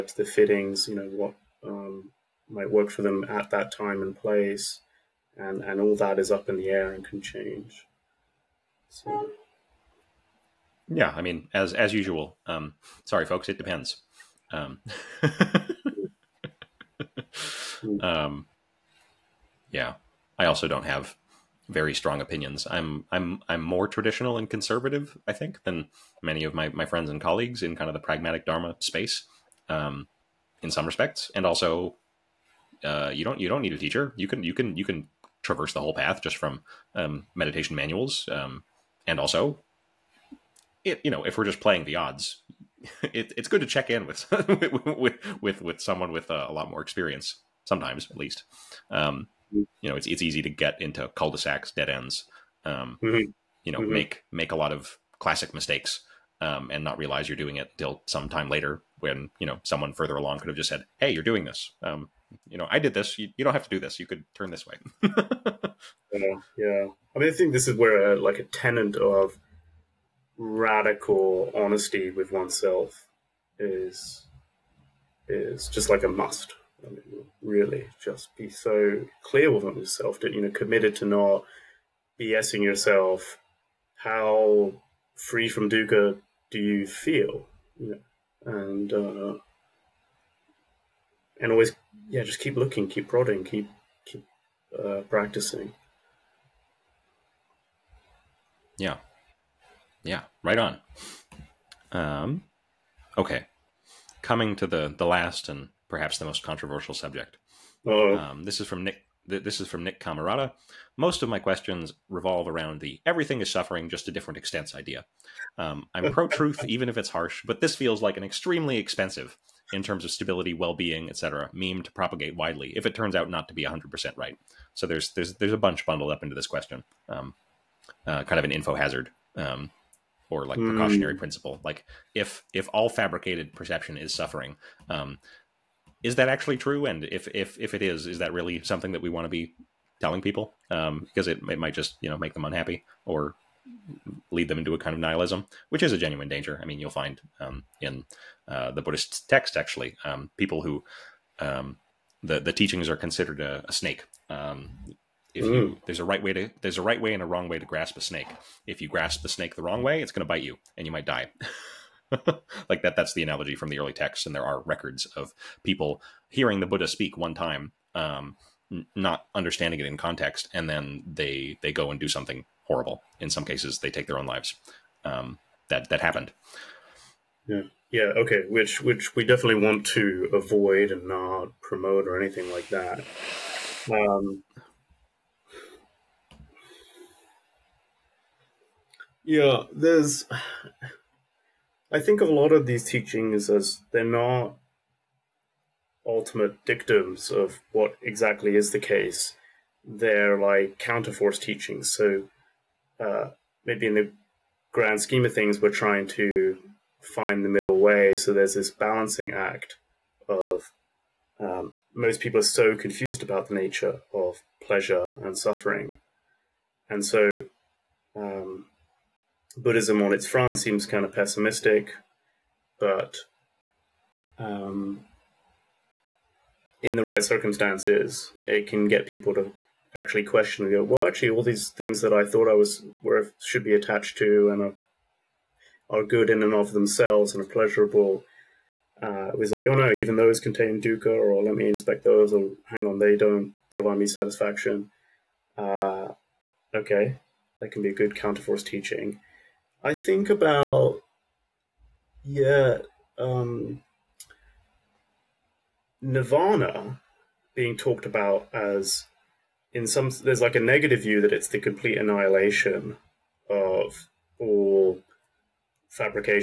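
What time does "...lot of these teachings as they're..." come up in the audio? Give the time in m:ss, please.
3:12.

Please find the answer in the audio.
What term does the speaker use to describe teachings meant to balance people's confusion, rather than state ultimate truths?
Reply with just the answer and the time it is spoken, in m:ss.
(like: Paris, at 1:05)
Counterforce teachings, at 3:20.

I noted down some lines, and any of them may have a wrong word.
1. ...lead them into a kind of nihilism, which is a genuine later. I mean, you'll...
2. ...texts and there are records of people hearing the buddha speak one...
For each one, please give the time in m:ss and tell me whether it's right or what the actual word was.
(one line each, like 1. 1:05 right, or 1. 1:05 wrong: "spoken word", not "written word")
1. 2:24 wrong: "danger", not "later"
2. 2:43 right.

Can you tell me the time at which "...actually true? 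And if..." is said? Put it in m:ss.
2:16.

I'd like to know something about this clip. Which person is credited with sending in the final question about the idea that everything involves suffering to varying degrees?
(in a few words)
Nick Cammarata.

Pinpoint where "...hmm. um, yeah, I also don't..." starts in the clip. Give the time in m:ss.
0:17.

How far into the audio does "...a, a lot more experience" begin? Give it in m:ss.
0:46.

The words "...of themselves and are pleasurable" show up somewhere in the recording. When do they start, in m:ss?
3:56.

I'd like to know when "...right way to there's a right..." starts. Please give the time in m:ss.
2:36.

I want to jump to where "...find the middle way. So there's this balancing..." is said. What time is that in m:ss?
3:27.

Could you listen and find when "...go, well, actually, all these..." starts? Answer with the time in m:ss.
3:50.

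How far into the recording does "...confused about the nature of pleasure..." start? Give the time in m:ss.
3:32.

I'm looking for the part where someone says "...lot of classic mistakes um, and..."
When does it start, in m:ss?
0:54.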